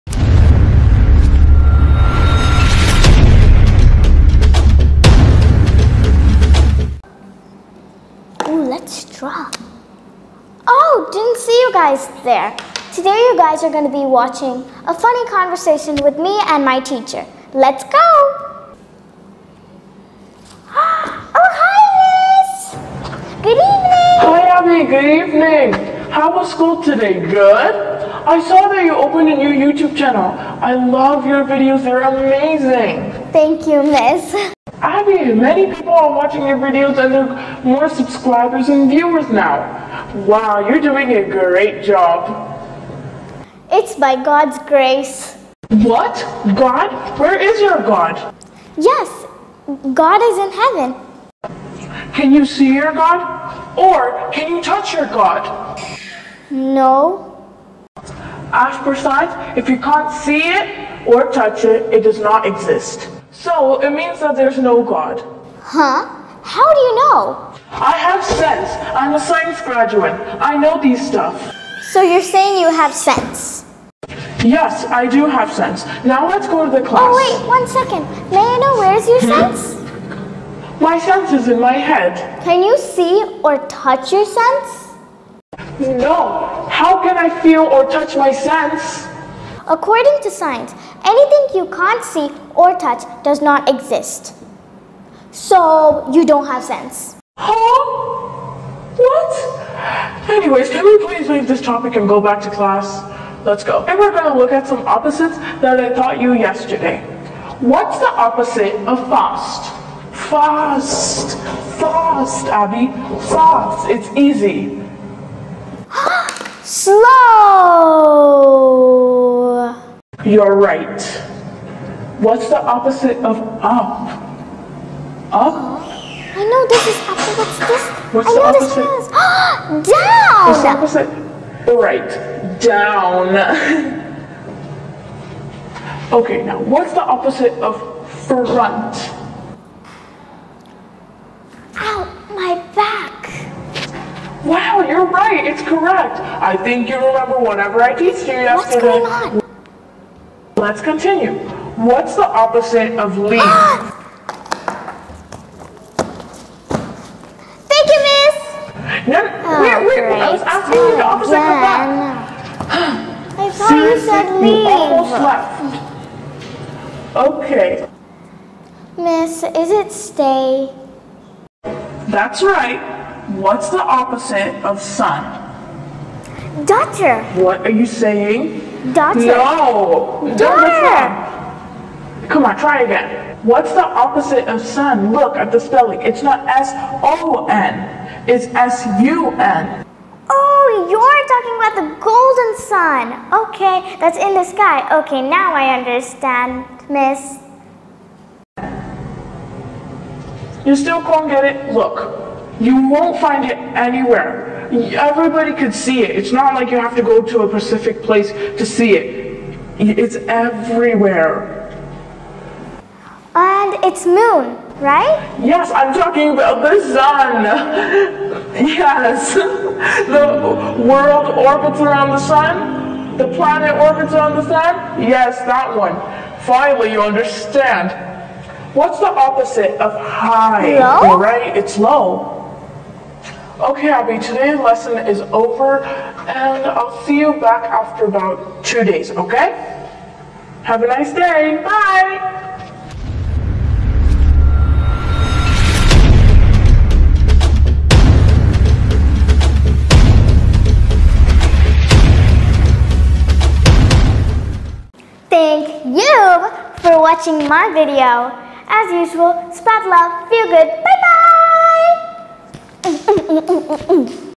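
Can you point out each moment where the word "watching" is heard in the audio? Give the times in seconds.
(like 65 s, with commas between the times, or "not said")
14 s, 36 s, 256 s.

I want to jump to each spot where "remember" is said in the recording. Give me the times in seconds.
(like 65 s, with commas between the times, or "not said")
147 s.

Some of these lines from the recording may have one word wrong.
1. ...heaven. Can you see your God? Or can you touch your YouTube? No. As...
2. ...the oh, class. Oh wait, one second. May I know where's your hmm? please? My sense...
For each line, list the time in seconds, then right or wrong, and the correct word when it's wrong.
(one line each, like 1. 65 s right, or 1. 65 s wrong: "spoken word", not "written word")
1. 50 s wrong: "God", not "YouTube"
2. 76 s wrong: "sense", not "please".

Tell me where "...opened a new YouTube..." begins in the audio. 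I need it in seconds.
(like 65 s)
28 s.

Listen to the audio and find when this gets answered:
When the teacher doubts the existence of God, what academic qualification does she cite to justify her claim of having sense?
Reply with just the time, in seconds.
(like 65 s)
69 s.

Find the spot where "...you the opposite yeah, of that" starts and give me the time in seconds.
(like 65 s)
160 s.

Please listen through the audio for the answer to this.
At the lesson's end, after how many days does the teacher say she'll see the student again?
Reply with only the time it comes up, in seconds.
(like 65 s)
238 s.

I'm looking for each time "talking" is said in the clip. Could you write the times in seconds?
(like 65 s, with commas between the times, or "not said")
191 s, 215 s.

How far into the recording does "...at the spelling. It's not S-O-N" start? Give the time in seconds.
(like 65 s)
185 s.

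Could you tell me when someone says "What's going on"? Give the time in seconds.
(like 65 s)
148 s.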